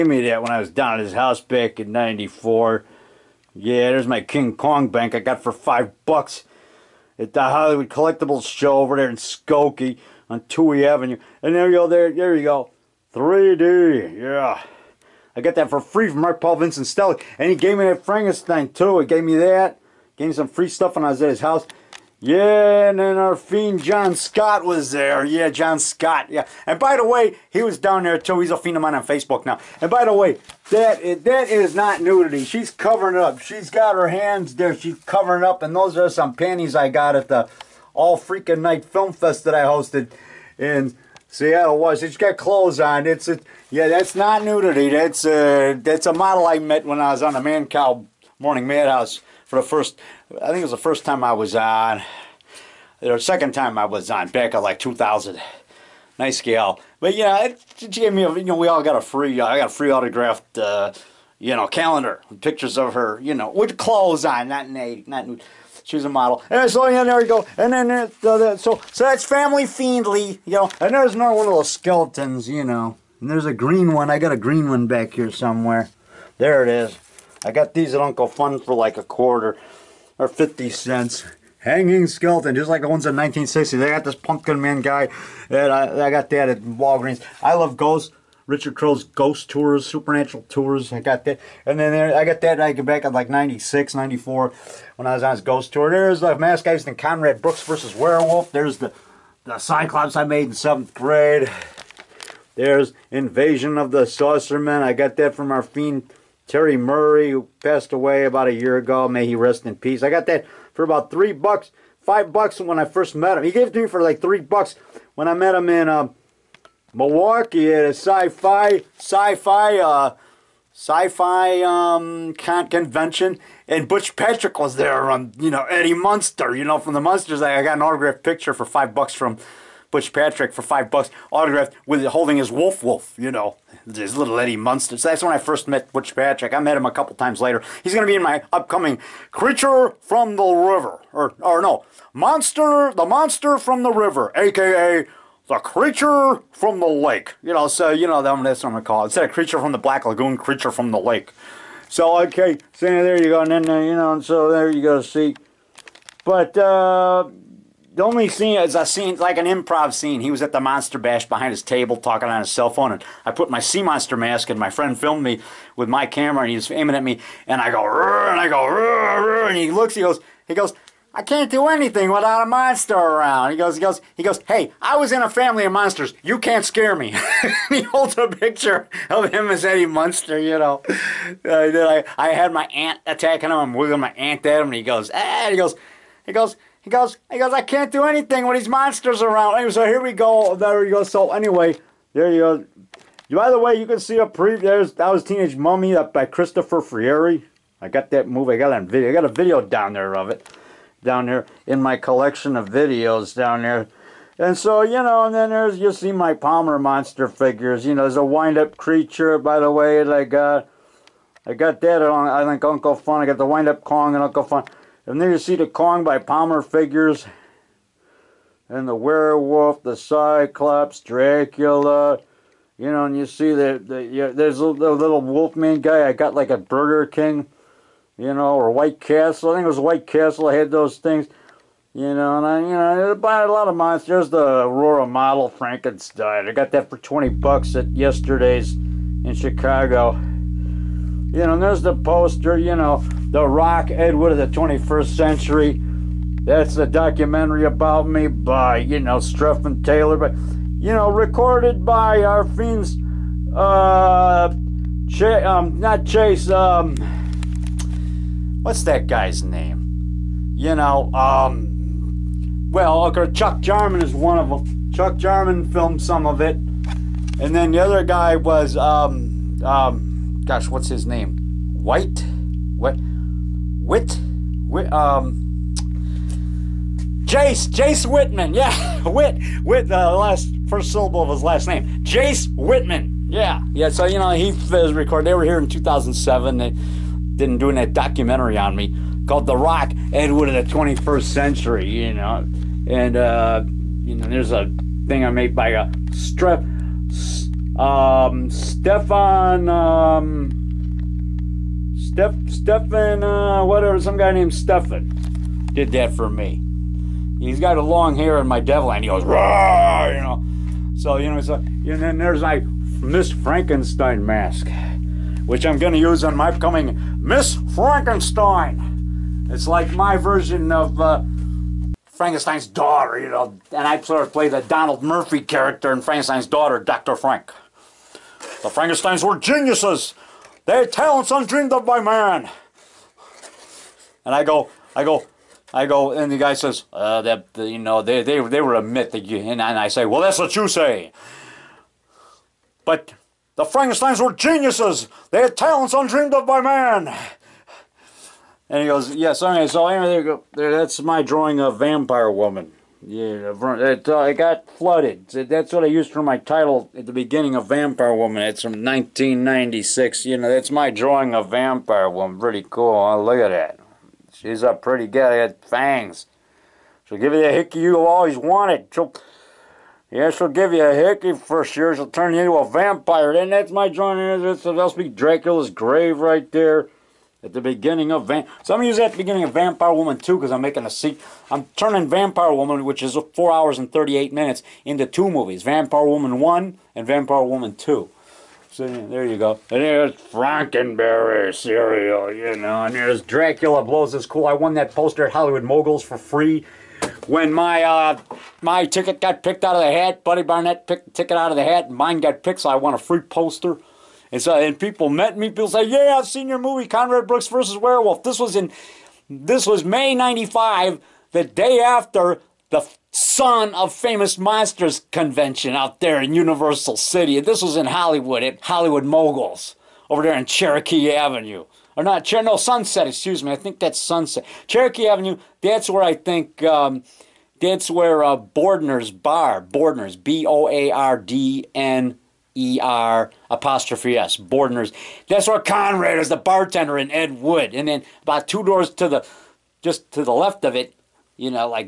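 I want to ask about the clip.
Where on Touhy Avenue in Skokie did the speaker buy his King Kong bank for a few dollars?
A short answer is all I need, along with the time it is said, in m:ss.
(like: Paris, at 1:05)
Hollywood Collectibles show, at 0:07.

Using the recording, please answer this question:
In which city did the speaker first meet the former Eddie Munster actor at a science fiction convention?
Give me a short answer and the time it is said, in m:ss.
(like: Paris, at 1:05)
Milwaukee, at 1:56.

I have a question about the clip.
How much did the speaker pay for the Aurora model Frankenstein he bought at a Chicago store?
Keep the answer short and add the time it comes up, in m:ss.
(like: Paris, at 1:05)
20 bucks, at 3:56.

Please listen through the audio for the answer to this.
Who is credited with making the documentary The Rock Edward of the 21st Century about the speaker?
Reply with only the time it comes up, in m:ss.
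4:09.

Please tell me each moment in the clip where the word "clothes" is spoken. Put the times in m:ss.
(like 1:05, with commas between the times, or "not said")
0:42, 1:03.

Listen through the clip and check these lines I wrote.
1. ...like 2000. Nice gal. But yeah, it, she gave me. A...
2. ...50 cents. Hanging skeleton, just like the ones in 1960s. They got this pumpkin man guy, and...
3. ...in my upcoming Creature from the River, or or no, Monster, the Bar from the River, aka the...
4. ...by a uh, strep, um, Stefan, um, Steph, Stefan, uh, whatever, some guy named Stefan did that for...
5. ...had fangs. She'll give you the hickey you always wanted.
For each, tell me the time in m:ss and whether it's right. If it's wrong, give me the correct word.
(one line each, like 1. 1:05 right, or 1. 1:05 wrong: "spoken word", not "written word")
1. 0:54 right
2. 1:20 right
3. 2:18 wrong: "Monster", not "Bar"
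4. 4:55 right
5. 6:05 right.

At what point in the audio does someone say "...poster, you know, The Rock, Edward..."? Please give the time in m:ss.
4:01.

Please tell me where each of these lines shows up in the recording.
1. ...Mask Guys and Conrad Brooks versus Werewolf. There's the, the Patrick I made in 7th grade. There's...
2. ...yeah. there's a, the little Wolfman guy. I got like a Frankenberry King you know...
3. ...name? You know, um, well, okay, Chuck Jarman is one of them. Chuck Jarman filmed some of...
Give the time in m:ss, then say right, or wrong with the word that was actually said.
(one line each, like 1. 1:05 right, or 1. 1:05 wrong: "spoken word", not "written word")
1. 1:36 wrong: "Cyclops", not "Patrick"
2. 3:44 wrong: "Burger", not "Frankenberry"
3. 4:19 right.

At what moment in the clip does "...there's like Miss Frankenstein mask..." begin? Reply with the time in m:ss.
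5:12.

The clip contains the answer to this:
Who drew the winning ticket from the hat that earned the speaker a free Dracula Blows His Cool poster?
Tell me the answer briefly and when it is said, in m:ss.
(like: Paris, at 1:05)
Buddy Barnett, at 6:40.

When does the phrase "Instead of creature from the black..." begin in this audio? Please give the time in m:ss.
2:29.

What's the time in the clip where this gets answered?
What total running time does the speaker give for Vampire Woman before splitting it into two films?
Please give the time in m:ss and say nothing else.
6:23.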